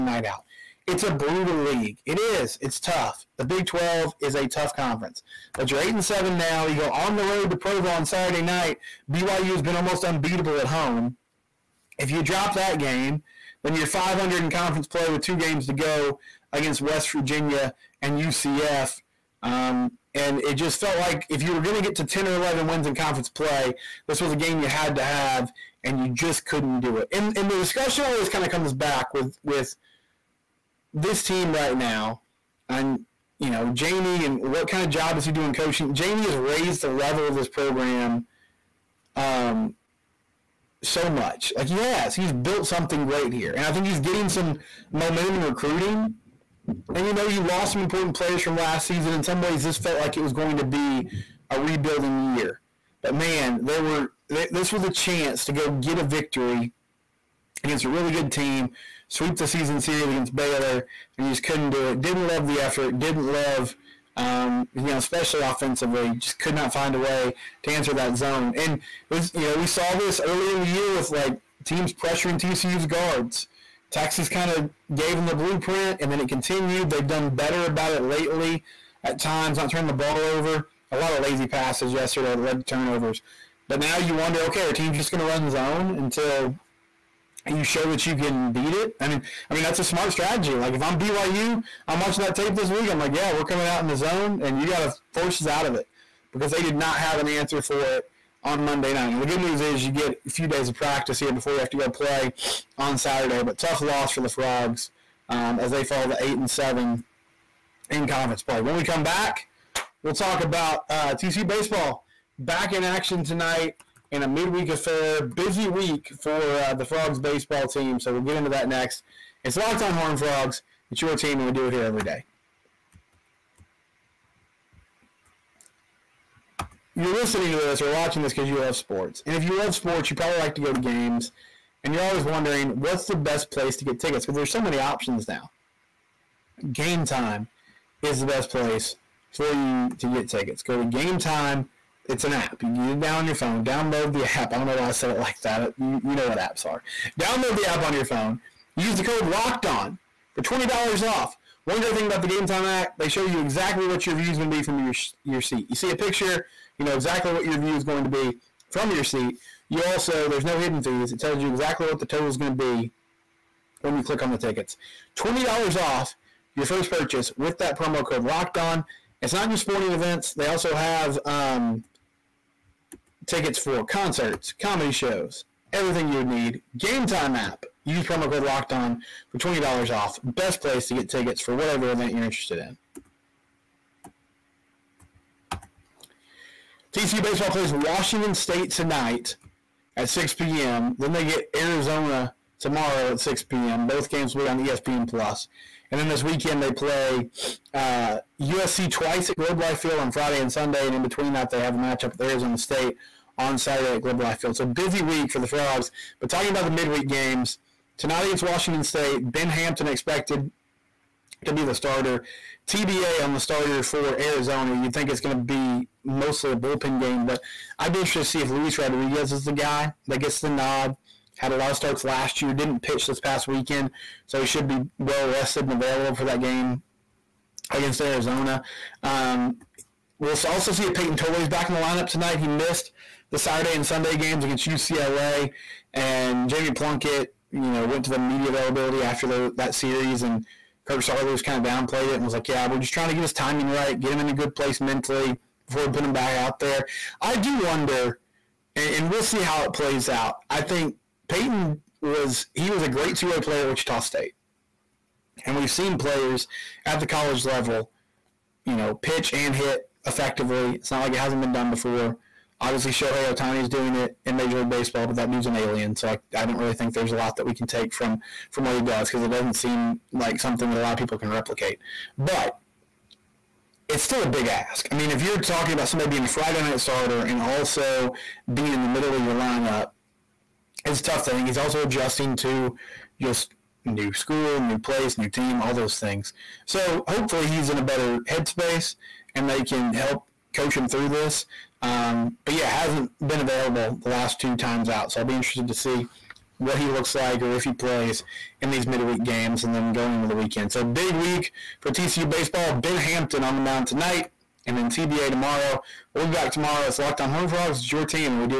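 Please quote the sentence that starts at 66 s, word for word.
Just could not find a way to answer that zone.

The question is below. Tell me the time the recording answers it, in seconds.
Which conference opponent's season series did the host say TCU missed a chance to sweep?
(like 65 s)
60 s.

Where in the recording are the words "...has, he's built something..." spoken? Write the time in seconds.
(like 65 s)
41 s.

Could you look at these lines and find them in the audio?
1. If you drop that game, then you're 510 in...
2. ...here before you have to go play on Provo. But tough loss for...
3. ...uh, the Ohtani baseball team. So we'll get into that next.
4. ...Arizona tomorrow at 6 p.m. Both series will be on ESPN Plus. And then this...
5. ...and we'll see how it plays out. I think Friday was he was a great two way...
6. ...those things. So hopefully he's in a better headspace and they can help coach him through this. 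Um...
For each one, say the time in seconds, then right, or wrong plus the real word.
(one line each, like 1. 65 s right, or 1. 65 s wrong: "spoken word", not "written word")
1. 11 s wrong: "500", not "510"
2. 101 s wrong: "Saturday", not "Provo"
3. 116 s wrong: "Frogs", not "Ohtani"
4. 191 s wrong: "games", not "series"
5. 248 s wrong: "Peyton", not "Friday"
6. 285 s right.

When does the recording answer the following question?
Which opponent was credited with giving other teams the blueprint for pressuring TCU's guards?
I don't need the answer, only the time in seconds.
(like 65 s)
73 s.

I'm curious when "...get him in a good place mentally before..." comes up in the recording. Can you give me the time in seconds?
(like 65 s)
243 s.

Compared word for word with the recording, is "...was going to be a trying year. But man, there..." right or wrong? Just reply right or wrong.
wrong.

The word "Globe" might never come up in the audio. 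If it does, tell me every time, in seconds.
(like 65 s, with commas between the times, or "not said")
199 s, 204 s.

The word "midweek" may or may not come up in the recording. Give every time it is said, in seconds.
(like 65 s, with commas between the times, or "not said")
114 s, 206 s, 298 s.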